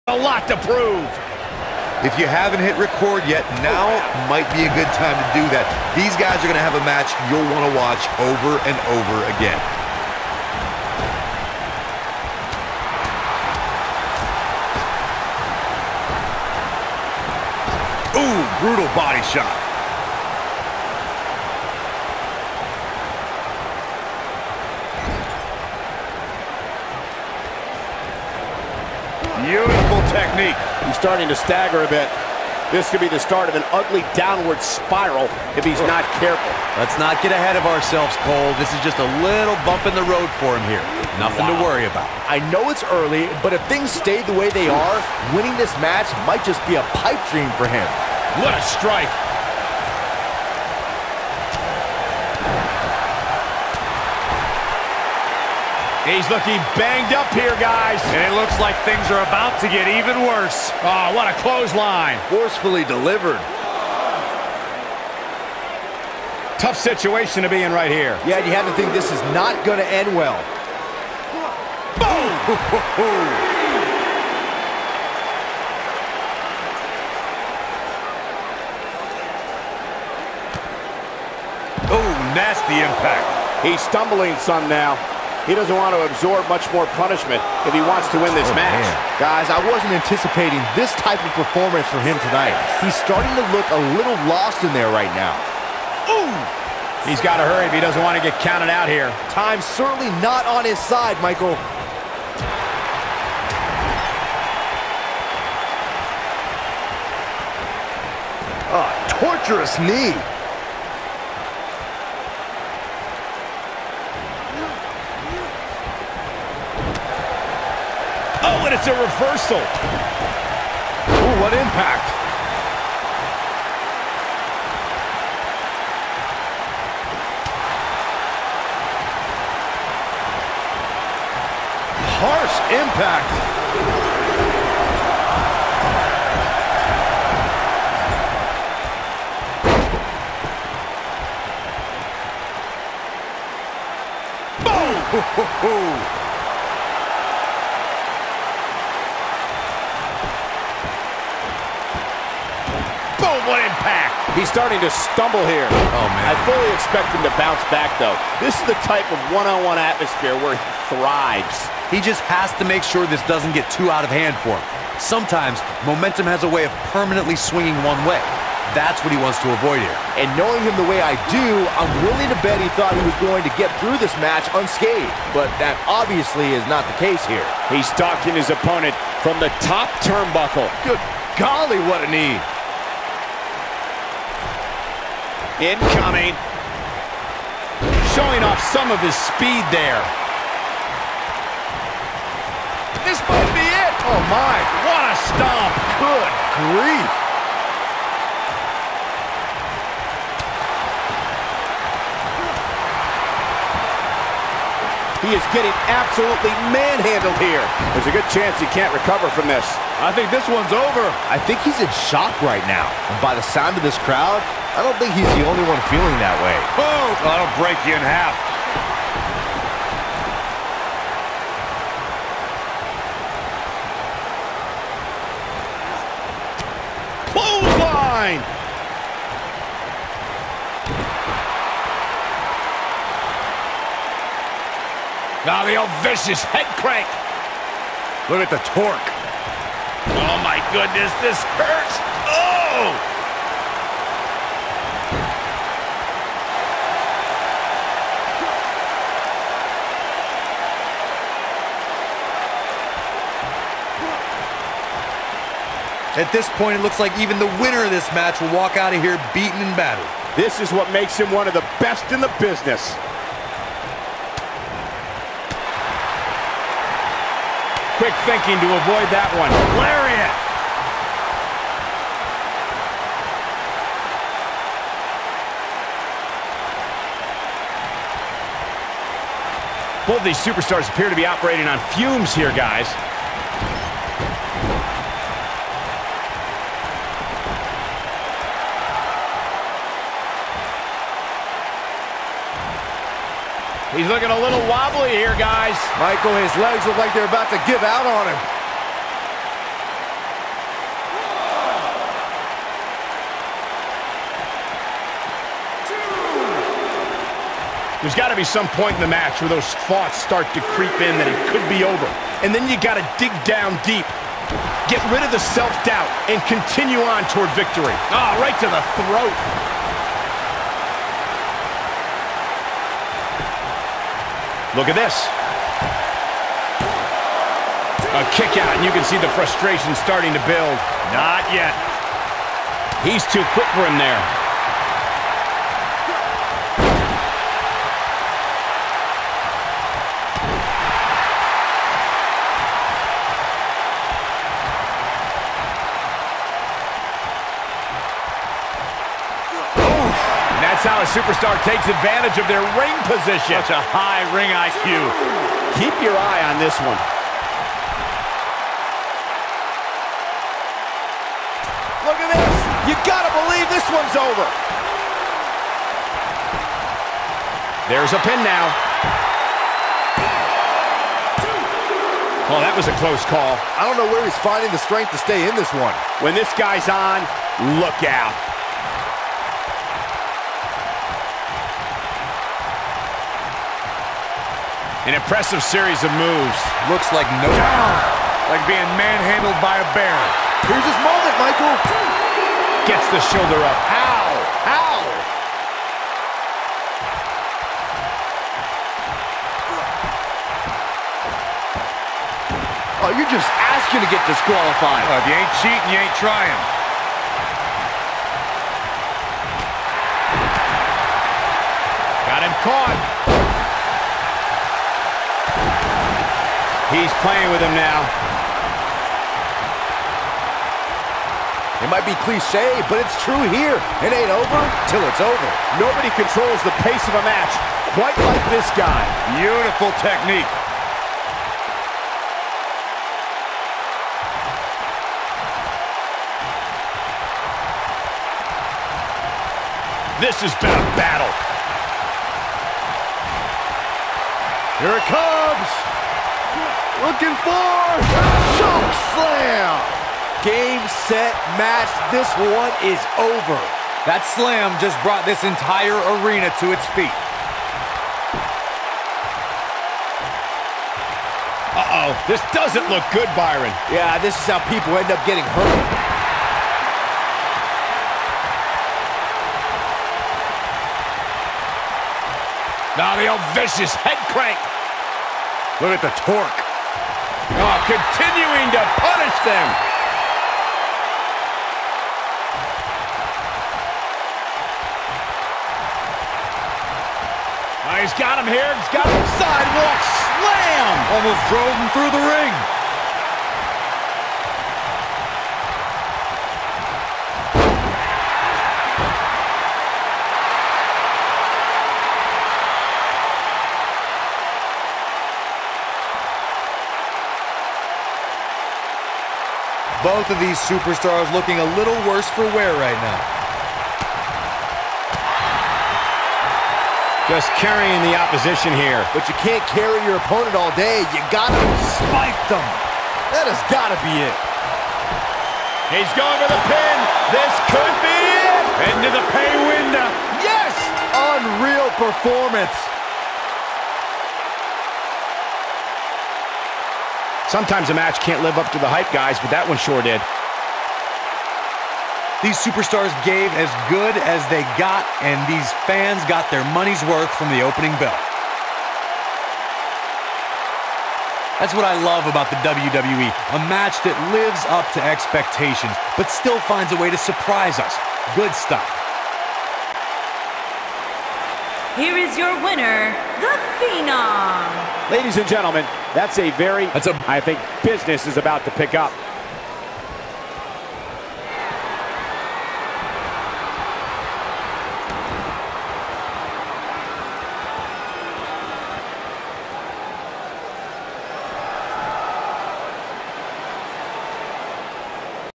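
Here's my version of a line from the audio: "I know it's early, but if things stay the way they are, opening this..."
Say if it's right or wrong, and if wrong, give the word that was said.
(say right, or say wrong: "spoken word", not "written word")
wrong: "winning", not "opening".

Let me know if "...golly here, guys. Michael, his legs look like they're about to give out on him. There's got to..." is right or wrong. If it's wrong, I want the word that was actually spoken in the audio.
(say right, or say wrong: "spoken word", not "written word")
wrong: "wobbly", not "golly".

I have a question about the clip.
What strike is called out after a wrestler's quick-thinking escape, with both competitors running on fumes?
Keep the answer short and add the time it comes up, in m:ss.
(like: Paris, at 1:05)
Lariat, at 4:29.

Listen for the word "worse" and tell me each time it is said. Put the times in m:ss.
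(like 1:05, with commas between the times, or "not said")
1:00, 8:32.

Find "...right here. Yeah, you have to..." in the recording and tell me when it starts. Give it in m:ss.
1:07.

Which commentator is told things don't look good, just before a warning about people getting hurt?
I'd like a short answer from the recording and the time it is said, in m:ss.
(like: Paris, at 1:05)
Byron, at 7:43.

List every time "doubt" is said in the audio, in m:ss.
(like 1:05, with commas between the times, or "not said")
5:15.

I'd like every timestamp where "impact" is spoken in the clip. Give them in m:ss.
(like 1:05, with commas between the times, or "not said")
1:22, 2:01, 2:12.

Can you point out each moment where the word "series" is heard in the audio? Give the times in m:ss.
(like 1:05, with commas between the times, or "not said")
6:25.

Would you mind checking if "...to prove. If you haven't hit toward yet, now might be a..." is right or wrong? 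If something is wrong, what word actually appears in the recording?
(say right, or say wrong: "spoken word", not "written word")
wrong: "record", not "toward".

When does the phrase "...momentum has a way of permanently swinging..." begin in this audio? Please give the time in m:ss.
2:45.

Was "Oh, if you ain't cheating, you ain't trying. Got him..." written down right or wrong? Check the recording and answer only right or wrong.
right.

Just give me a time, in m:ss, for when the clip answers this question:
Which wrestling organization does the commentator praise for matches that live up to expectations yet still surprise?
9:12.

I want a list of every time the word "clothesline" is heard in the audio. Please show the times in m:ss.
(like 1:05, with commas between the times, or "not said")
1:01, 3:47.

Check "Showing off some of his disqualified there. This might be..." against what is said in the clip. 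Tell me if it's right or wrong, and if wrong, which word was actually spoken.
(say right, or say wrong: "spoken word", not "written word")
wrong: "speed", not "disqualified".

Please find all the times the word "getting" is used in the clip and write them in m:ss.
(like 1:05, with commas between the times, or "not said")
3:25, 7:45.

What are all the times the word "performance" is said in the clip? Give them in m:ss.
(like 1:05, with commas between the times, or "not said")
1:31, 8:51.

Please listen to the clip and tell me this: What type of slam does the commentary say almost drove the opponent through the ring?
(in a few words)
Sidewalk slam.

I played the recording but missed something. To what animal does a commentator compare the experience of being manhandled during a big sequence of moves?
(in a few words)
A bear.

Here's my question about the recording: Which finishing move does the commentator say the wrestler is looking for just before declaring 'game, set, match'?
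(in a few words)
Shock slam.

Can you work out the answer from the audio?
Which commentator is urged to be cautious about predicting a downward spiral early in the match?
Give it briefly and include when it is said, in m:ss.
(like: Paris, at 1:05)
Cole, at 0:38.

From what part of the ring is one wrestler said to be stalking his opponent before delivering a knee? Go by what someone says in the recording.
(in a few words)
Top turnbuckle.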